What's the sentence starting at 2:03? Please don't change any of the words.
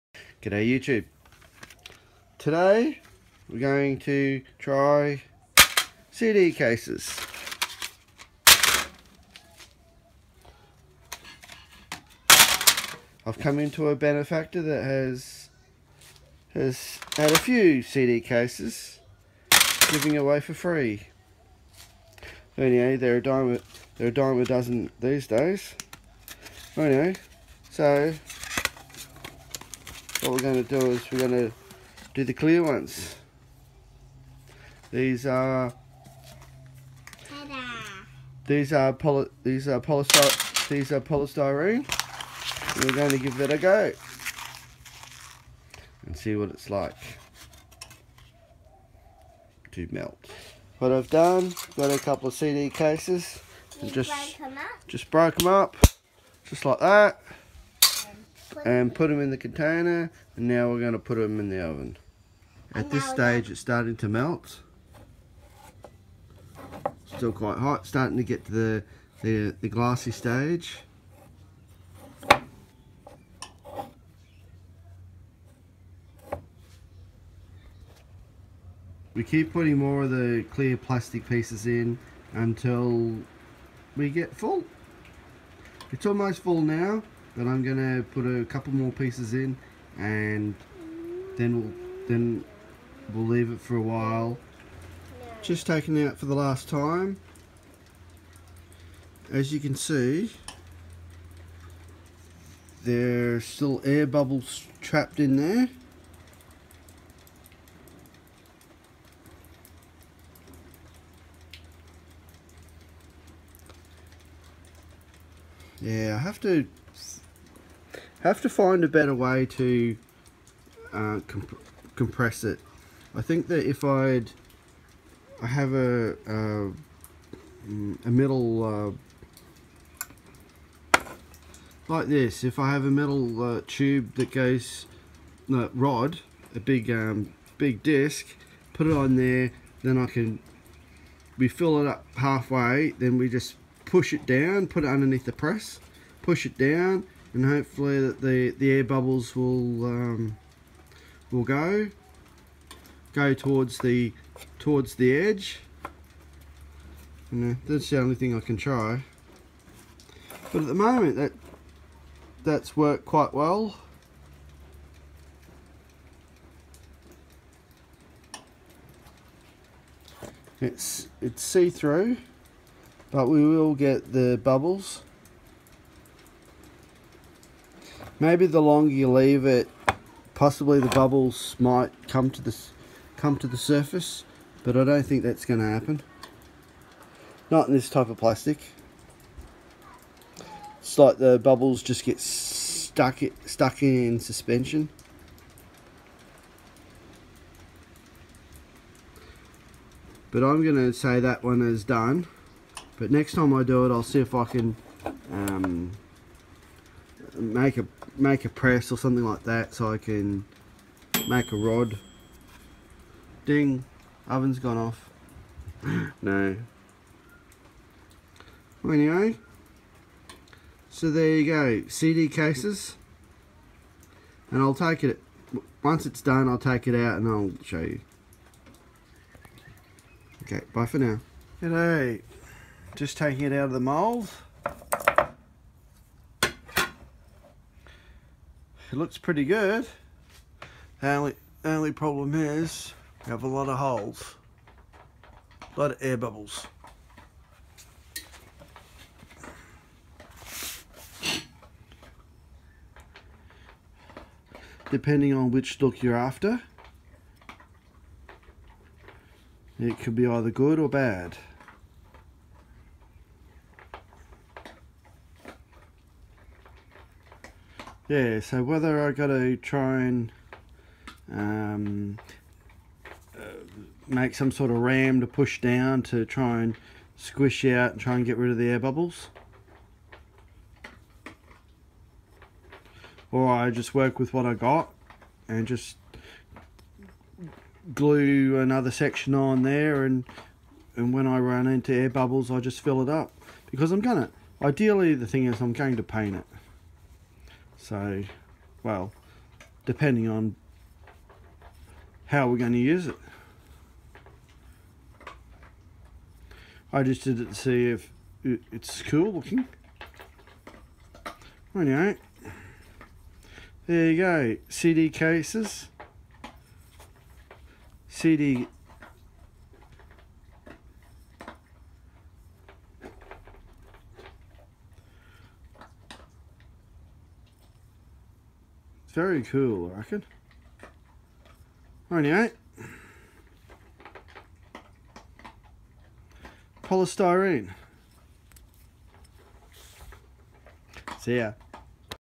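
I think that if I'd I have a a, a uh, like this.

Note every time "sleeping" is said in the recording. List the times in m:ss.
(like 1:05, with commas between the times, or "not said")
not said.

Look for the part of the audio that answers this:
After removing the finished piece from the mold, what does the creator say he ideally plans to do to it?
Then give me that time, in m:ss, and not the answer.
4:56.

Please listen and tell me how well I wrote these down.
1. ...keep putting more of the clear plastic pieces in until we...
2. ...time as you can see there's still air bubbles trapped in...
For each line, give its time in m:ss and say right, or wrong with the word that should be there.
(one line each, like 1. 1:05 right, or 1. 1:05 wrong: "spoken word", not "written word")
1. 1:19 right
2. 1:36 right.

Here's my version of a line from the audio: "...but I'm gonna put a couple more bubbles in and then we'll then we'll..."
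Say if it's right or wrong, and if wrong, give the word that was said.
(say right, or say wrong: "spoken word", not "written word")
wrong: "pieces", not "bubbles".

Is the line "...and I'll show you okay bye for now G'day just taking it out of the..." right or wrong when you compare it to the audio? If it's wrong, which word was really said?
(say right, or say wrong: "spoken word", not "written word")
right.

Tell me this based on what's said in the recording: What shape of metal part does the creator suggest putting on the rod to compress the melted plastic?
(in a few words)
Big disc.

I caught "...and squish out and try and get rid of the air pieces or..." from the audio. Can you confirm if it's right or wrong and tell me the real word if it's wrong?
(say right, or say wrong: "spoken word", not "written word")
wrong: "bubbles", not "pieces".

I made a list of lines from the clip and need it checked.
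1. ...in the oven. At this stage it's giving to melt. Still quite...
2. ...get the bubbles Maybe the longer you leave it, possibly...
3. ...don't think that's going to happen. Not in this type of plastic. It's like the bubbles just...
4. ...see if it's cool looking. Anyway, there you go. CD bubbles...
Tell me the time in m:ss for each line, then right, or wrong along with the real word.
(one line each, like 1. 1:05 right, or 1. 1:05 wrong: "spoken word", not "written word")
1. 1:01 wrong: "starting", not "giving"
2. 2:53 right
3. 3:04 right
4. 5:07 wrong: "cases", not "bubbles".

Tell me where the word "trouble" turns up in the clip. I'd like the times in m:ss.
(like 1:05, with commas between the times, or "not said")
not said.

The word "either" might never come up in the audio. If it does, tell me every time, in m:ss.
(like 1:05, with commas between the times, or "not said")
4:20.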